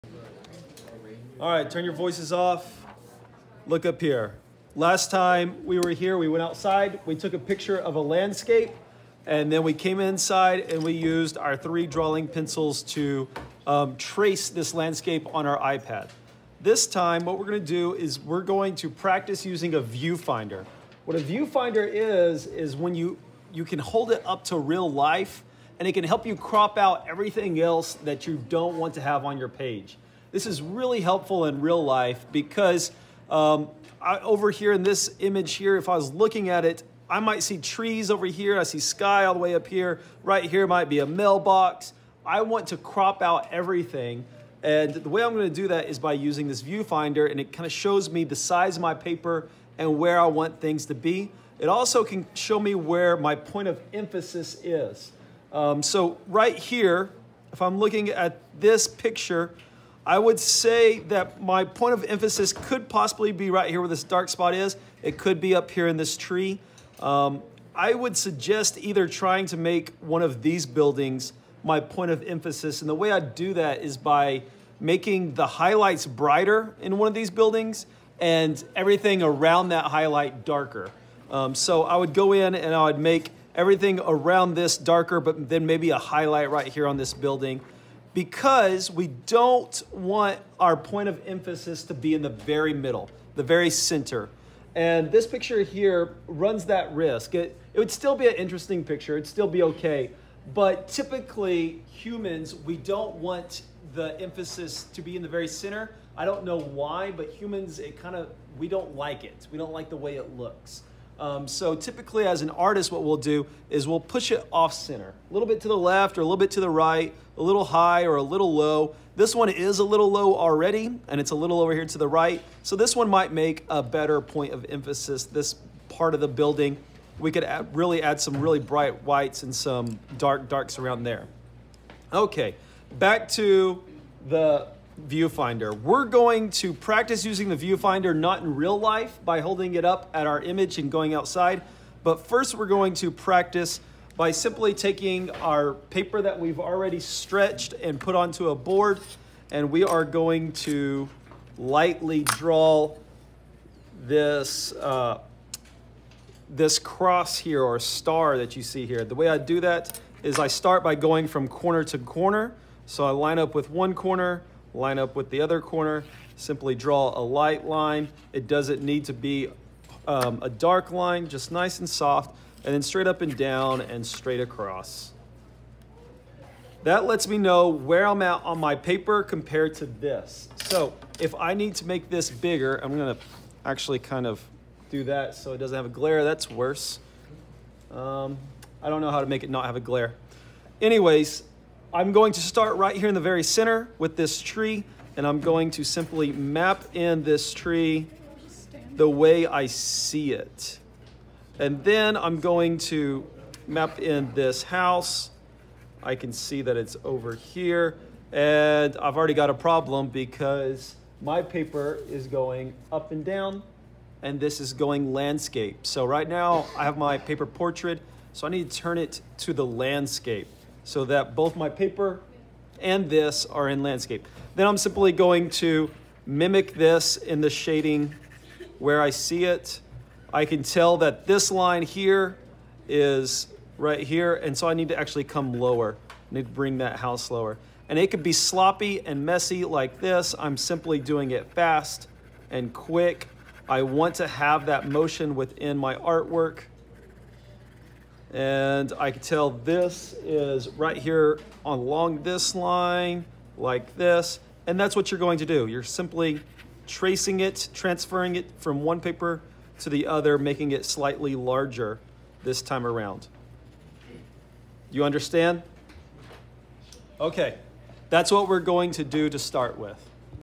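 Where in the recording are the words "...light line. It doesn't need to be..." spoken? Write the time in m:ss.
2:47.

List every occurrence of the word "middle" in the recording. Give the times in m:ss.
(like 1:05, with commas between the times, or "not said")
1:32.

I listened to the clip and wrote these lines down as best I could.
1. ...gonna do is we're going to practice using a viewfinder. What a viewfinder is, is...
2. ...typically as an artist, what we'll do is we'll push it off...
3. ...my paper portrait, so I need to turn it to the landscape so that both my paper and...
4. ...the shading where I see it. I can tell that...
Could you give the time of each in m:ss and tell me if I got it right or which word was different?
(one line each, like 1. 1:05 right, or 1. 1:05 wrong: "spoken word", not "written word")
1. 0:17 right
2. 1:51 right
3. 3:36 right
4. 3:47 right.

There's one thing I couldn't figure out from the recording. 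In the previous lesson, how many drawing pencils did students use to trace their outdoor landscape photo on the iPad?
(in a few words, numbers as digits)
3.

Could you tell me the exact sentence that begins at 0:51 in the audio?
It also can show me where my point of emphasis is.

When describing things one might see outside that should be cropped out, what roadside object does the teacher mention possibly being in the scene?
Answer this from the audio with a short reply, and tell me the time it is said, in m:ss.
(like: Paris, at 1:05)
mailbox, at 0:41.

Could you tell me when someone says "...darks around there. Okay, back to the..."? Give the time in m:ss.
2:10.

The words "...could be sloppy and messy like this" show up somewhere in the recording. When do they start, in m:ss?
3:58.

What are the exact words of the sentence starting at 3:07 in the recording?
Um, I don't know how to make it not have a glare.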